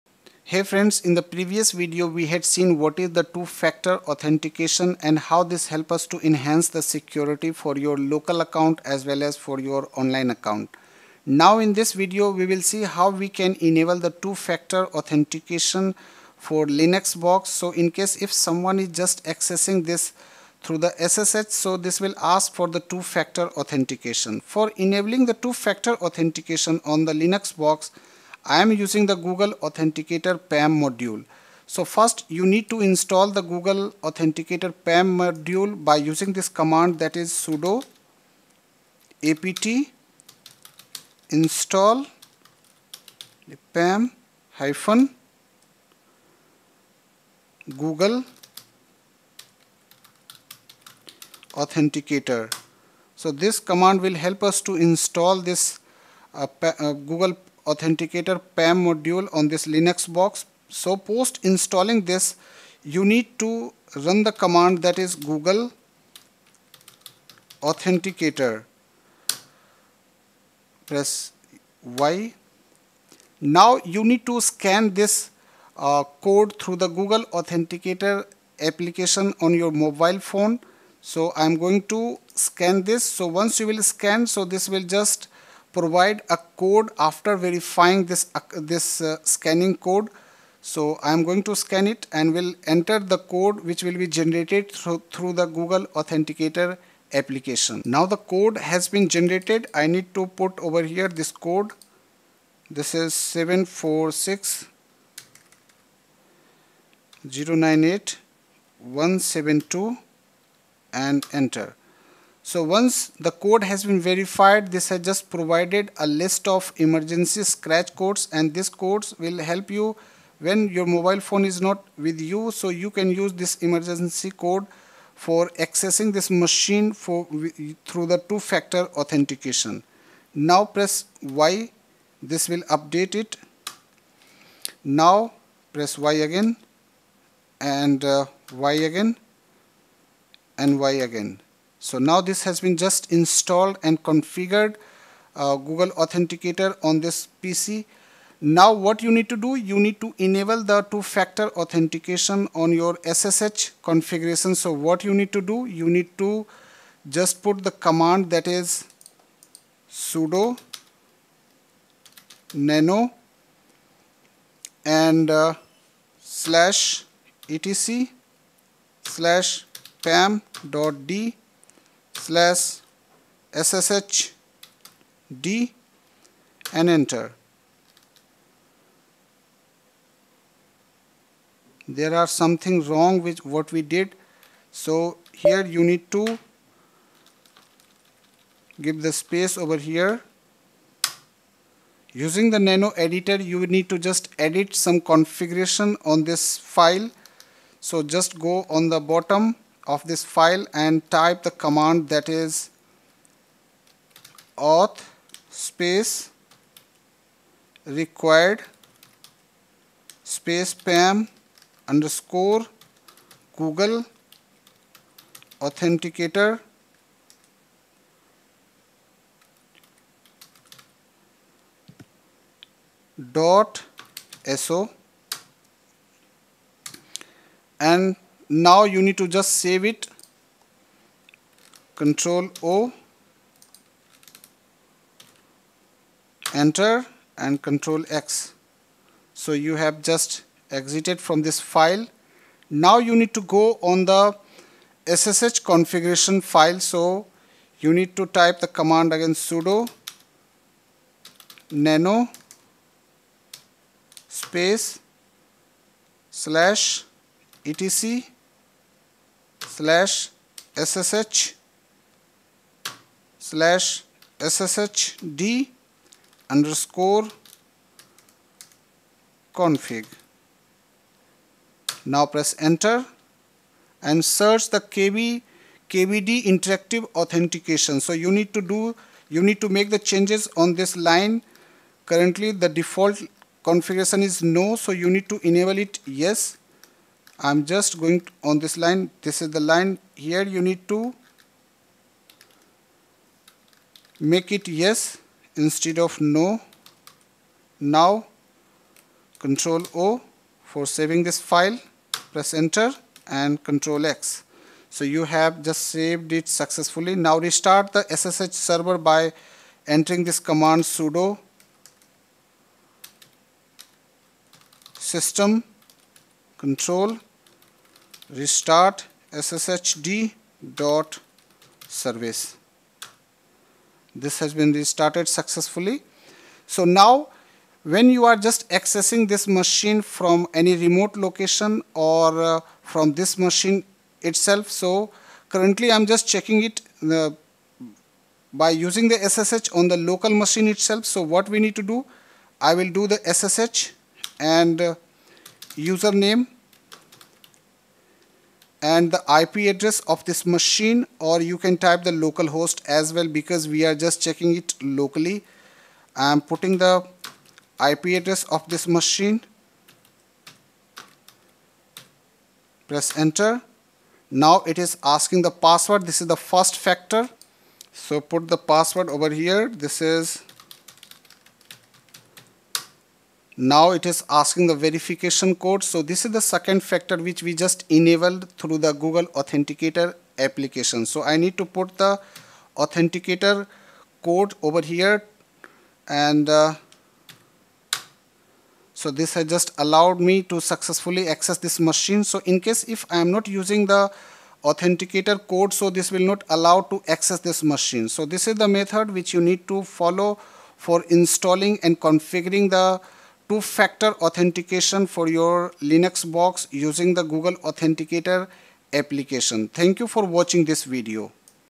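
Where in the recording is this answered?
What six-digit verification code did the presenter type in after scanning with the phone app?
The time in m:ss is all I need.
1:43.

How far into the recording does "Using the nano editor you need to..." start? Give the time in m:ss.
3:12.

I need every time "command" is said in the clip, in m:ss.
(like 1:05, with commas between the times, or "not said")
0:36, 0:53, 1:04, 2:37, 3:21, 4:08, 5:10.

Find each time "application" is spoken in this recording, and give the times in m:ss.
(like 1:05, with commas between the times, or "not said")
1:18, 1:37, 6:20, 6:48.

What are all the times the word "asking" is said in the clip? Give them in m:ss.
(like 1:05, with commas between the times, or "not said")
6:05, 6:14.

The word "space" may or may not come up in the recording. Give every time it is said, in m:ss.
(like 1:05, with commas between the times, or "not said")
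3:09, 3:25, 3:30, 4:14.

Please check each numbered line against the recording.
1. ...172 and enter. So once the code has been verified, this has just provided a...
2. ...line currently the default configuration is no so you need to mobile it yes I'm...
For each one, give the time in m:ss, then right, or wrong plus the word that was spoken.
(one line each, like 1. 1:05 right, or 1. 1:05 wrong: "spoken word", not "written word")
1. 1:48 right
2. 4:41 wrong: "enable", not "mobile".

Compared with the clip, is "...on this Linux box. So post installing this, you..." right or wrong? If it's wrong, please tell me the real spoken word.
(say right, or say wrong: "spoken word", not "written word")
right.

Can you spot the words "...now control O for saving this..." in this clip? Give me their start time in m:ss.
4:57.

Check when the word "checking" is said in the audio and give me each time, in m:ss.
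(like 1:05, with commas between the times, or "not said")
5:36, 5:54.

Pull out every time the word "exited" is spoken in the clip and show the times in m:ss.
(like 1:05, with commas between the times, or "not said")
4:00.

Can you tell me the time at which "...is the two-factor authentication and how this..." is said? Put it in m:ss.
0:02.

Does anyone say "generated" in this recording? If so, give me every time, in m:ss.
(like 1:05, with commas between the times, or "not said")
1:34, 1:39.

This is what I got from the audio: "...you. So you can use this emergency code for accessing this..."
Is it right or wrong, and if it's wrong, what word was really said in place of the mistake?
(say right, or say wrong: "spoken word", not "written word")
right.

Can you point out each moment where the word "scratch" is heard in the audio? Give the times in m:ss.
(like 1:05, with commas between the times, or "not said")
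1:57.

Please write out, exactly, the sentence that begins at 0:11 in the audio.
Now in this video we will see how we can enable the two-factor authentication for Linux box.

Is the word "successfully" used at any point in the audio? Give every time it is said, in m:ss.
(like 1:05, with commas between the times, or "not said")
5:06, 5:25, 6:30.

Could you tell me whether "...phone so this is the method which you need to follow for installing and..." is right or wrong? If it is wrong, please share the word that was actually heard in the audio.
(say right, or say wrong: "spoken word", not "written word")
wrong: "machine", not "phone".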